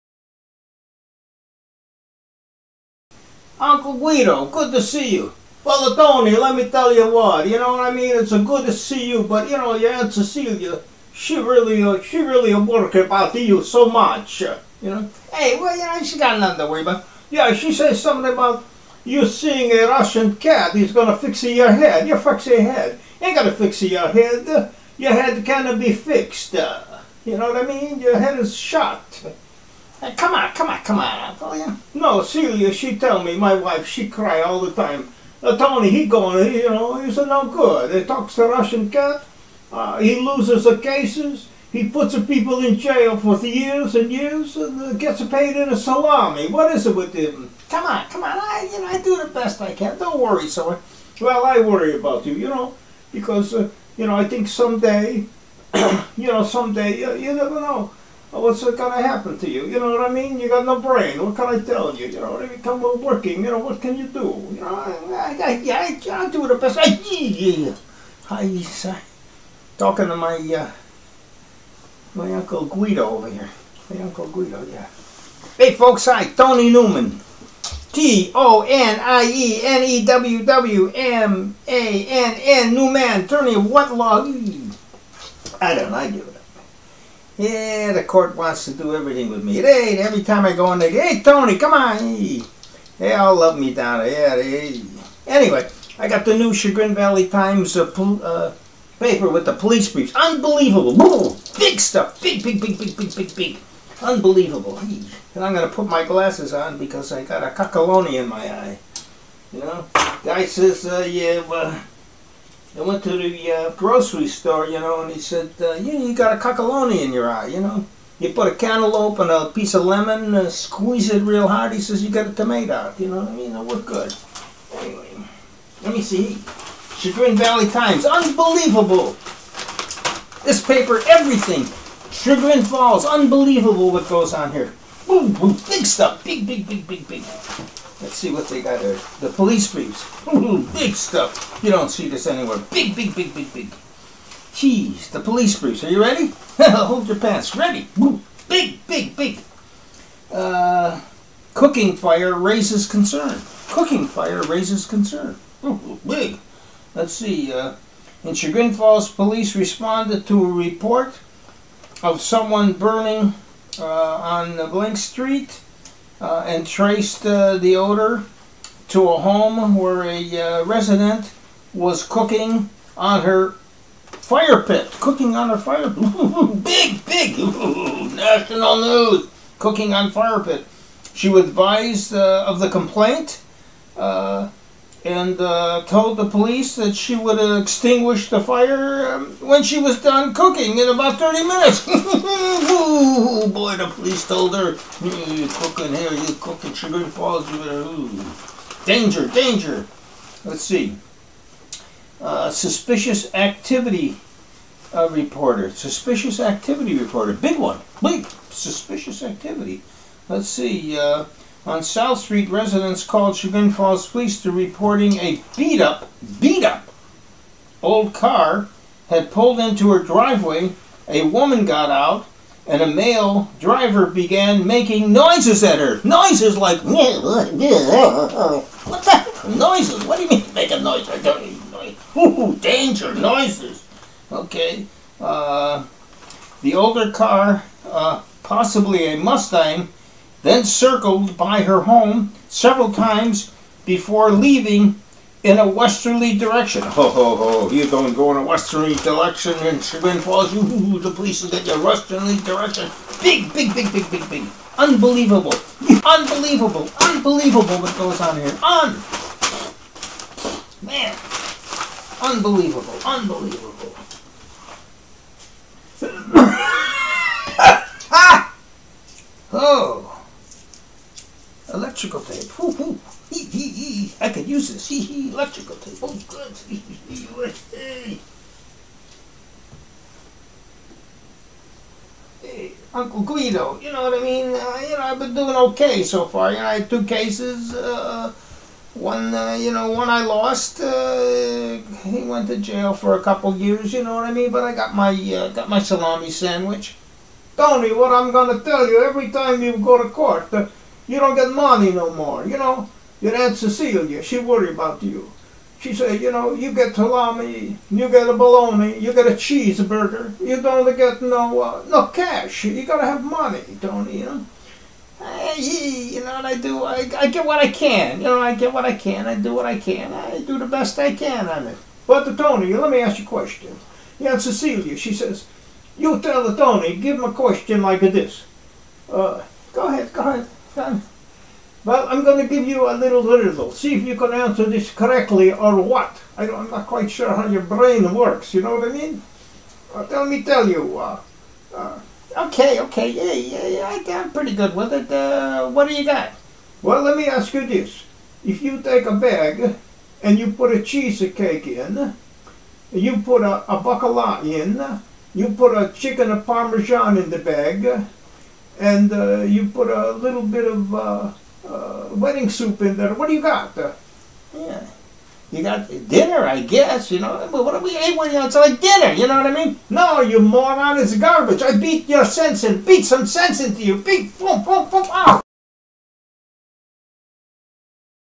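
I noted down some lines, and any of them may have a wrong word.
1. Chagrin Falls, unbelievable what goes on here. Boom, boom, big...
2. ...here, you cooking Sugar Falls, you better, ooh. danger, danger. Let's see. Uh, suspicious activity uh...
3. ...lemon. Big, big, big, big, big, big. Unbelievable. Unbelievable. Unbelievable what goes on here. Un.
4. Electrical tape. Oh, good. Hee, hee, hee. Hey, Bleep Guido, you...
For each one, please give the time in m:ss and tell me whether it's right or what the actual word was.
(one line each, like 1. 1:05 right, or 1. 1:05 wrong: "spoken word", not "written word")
1. 2:12 right
2. 3:15 right
3. 4:12 wrong: "direction", not "lemon"
4. 4:35 wrong: "Uncle", not "Bleep".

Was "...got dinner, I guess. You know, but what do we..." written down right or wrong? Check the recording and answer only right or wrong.
right.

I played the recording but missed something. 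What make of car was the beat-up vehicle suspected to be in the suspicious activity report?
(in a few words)
Mustang.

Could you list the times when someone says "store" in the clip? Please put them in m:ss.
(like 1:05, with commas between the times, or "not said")
1:54.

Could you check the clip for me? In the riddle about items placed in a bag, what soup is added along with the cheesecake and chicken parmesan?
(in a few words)
wedding soup.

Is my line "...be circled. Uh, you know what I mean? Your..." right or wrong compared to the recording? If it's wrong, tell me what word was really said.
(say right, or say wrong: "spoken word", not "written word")
wrong: "fixed", not "circled".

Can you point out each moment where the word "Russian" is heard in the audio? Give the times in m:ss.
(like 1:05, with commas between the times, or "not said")
0:19, 0:38.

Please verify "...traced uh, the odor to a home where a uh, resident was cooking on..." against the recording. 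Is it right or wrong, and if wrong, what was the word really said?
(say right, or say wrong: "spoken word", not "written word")
right.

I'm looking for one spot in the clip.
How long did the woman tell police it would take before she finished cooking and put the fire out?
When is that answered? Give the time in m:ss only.
3:10.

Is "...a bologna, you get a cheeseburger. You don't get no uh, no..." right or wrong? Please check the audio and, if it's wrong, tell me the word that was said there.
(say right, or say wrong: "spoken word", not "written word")
right.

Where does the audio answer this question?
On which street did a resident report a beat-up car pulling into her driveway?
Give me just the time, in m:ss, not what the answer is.
3:31.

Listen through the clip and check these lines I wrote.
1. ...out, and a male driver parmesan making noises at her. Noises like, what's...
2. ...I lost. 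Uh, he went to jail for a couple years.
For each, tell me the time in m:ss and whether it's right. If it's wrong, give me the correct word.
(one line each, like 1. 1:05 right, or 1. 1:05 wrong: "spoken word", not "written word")
1. 3:41 wrong: "began", not "parmesan"
2. 4:50 right.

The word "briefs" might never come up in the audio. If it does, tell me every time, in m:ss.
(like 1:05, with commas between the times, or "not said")
1:39, 2:19, 2:25.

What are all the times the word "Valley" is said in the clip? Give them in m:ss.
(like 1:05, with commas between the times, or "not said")
1:36, 2:07.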